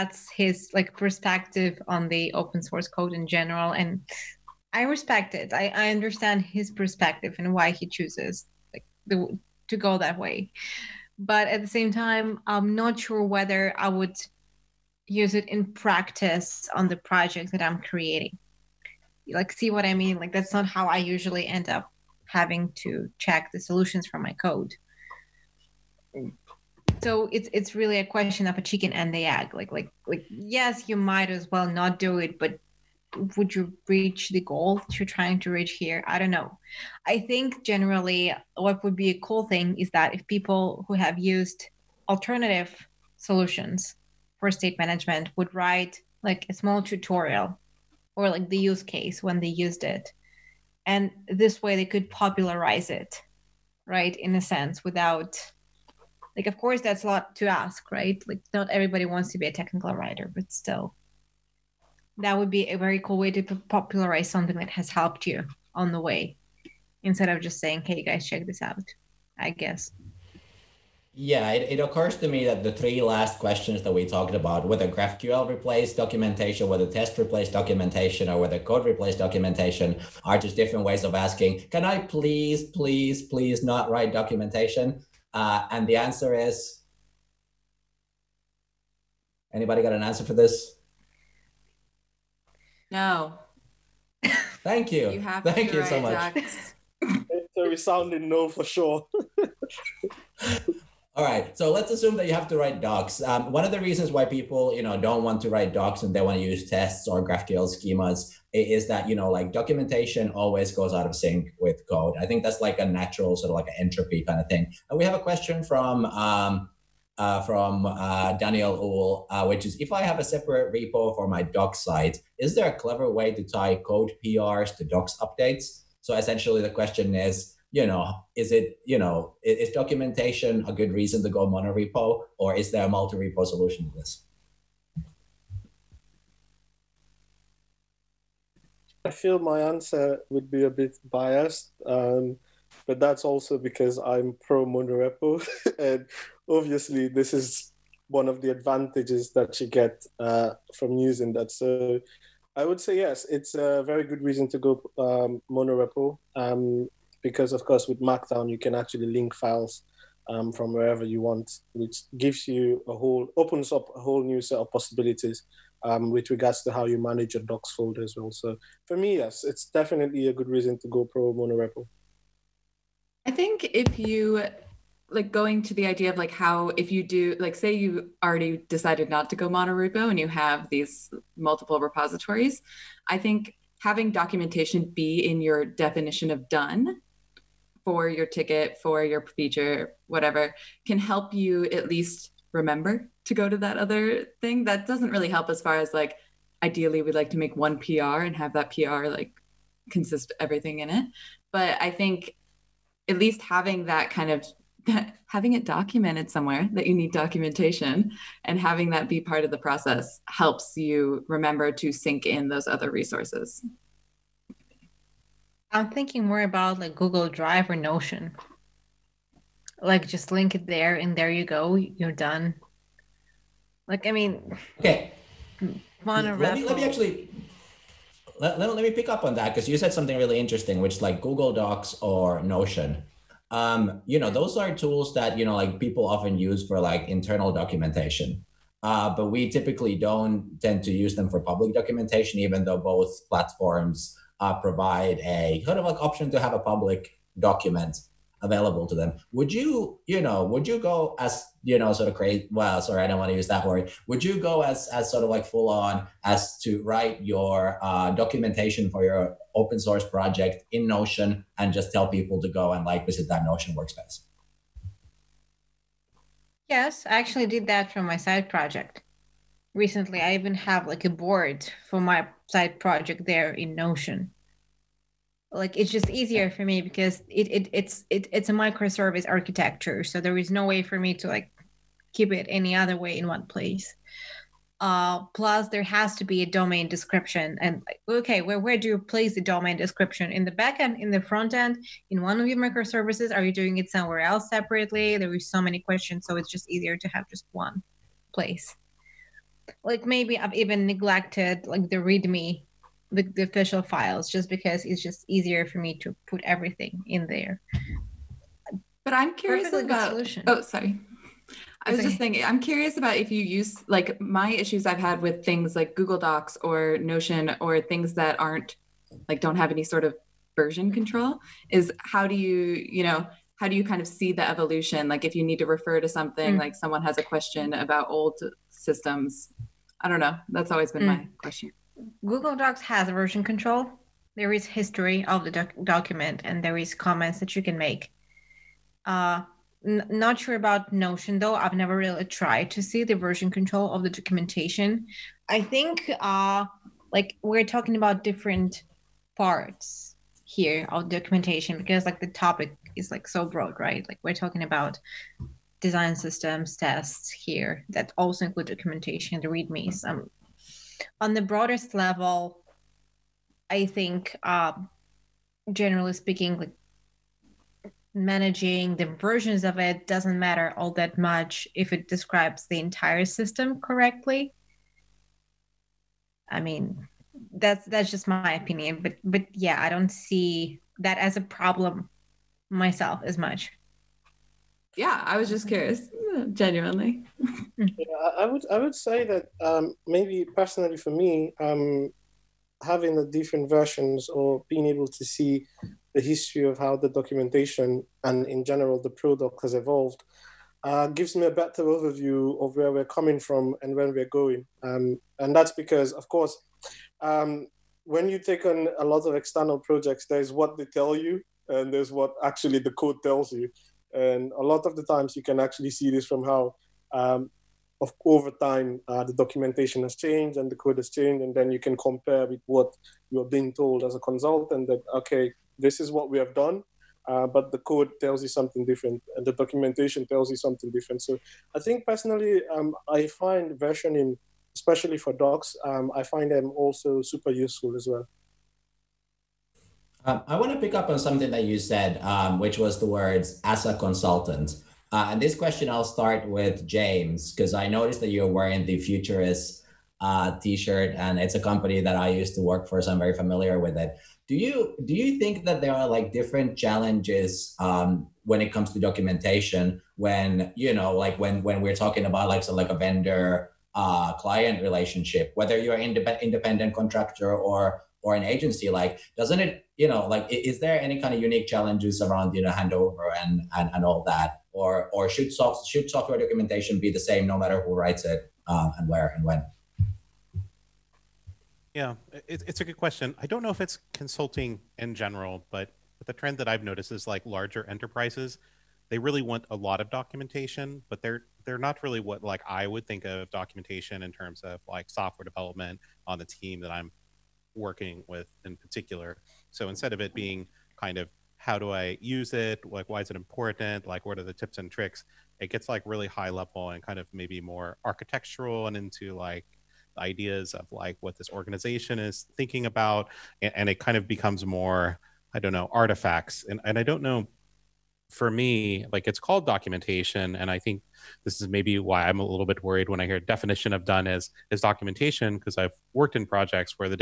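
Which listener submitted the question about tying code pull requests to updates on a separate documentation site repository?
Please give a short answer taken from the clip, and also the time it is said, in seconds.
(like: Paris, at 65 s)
Daniel Uhl, at 118 s.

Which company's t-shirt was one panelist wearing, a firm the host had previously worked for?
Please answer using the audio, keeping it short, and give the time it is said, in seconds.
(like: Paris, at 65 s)
Futurice, at 448 s.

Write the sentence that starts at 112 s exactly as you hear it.
I think that's like a natural sort of like an entropy kind of thing.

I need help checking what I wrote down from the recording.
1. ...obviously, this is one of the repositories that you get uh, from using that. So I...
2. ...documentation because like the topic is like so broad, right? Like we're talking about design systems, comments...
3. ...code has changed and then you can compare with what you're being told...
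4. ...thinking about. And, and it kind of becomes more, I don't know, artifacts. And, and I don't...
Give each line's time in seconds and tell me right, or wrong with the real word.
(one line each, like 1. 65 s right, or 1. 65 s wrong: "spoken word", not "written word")
1. 146 s wrong: "advantages", not "repositories"
2. 351 s wrong: "tests", not "comments"
3. 420 s right
4. 512 s right.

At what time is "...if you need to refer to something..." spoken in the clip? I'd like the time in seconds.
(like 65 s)
325 s.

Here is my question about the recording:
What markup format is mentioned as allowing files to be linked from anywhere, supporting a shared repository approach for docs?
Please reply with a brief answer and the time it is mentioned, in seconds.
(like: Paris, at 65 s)
Markdown, at 157 s.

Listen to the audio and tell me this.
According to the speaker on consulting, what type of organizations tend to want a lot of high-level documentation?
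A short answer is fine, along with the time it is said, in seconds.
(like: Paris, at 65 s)
larger enterprises, at 487 s.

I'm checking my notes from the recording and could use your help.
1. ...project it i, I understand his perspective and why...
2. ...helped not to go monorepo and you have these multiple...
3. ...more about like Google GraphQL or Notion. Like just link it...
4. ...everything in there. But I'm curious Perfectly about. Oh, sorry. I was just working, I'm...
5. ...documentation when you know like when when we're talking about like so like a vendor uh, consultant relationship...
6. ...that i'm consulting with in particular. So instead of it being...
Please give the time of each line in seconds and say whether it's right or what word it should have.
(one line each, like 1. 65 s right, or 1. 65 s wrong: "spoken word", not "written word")
1. 4 s wrong: "respect", not "project"
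2. 178 s wrong: "decided", not "helped"
3. 216 s wrong: "Drive", not "GraphQL"
4. 306 s wrong: "thinking", not "working"
5. 458 s wrong: "client", not "consultant"
6. 496 s wrong: "working", not "consulting".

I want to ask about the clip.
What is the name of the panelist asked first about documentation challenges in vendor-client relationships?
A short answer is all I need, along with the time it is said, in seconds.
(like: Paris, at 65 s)
James, at 446 s.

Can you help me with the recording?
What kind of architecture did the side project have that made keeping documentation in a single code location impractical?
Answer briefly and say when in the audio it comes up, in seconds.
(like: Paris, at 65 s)
microservice architecture, at 278 s.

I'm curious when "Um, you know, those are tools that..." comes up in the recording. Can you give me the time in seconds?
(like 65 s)
233 s.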